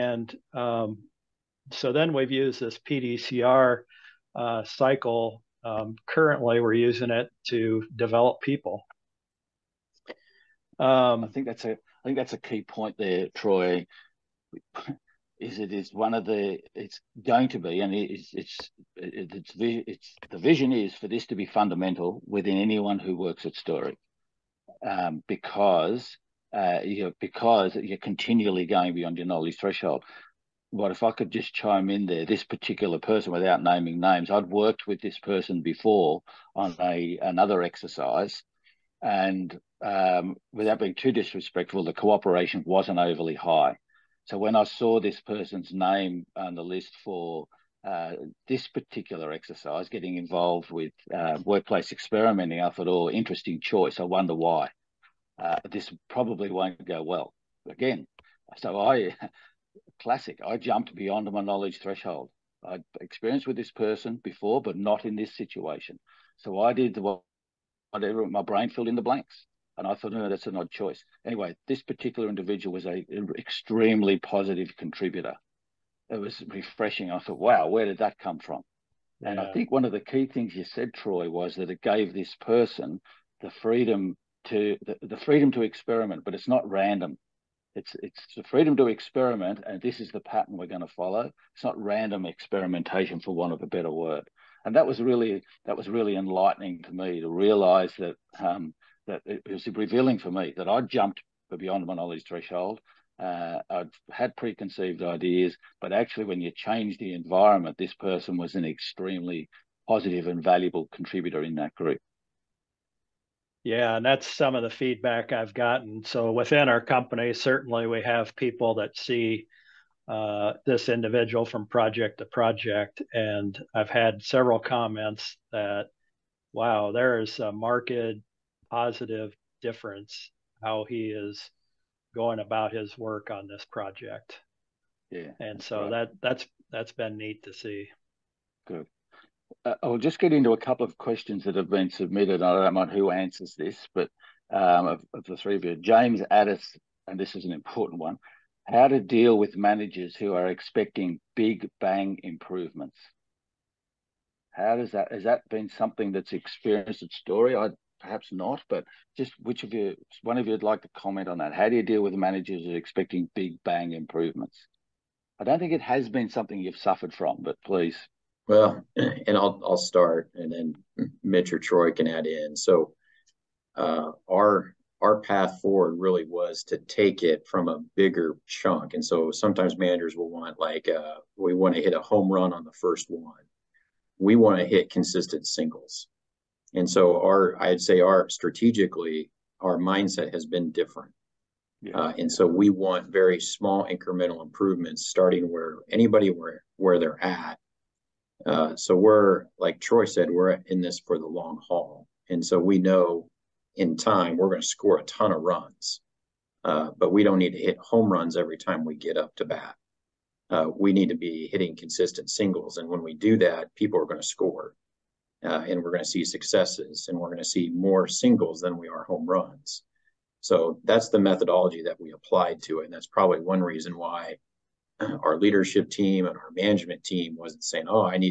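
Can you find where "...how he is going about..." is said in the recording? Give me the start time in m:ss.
2:10.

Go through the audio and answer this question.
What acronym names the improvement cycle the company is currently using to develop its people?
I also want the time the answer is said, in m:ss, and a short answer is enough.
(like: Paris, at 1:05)
PDCR, at 0:02.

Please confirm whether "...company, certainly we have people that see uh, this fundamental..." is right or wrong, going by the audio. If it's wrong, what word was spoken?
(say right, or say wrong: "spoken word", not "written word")
wrong: "individual", not "fundamental".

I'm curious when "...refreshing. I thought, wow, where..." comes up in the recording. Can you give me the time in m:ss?
1:16.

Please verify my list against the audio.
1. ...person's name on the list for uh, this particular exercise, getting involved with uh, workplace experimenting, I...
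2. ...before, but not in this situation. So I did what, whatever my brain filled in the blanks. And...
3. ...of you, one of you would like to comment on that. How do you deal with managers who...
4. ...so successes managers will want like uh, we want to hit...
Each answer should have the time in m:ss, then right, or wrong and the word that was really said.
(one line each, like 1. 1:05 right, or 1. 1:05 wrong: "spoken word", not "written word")
1. 0:45 right
2. 1:04 right
3. 2:39 right
4. 2:59 wrong: "sometimes", not "successes".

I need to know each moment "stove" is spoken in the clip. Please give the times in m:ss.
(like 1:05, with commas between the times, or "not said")
not said.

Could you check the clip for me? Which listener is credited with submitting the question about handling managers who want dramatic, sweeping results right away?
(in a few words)
James Addis.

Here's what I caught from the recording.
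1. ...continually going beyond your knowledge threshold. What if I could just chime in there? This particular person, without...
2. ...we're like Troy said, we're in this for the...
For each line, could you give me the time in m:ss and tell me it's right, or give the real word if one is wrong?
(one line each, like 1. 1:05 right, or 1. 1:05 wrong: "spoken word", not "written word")
1. 0:27 right
2. 3:18 right.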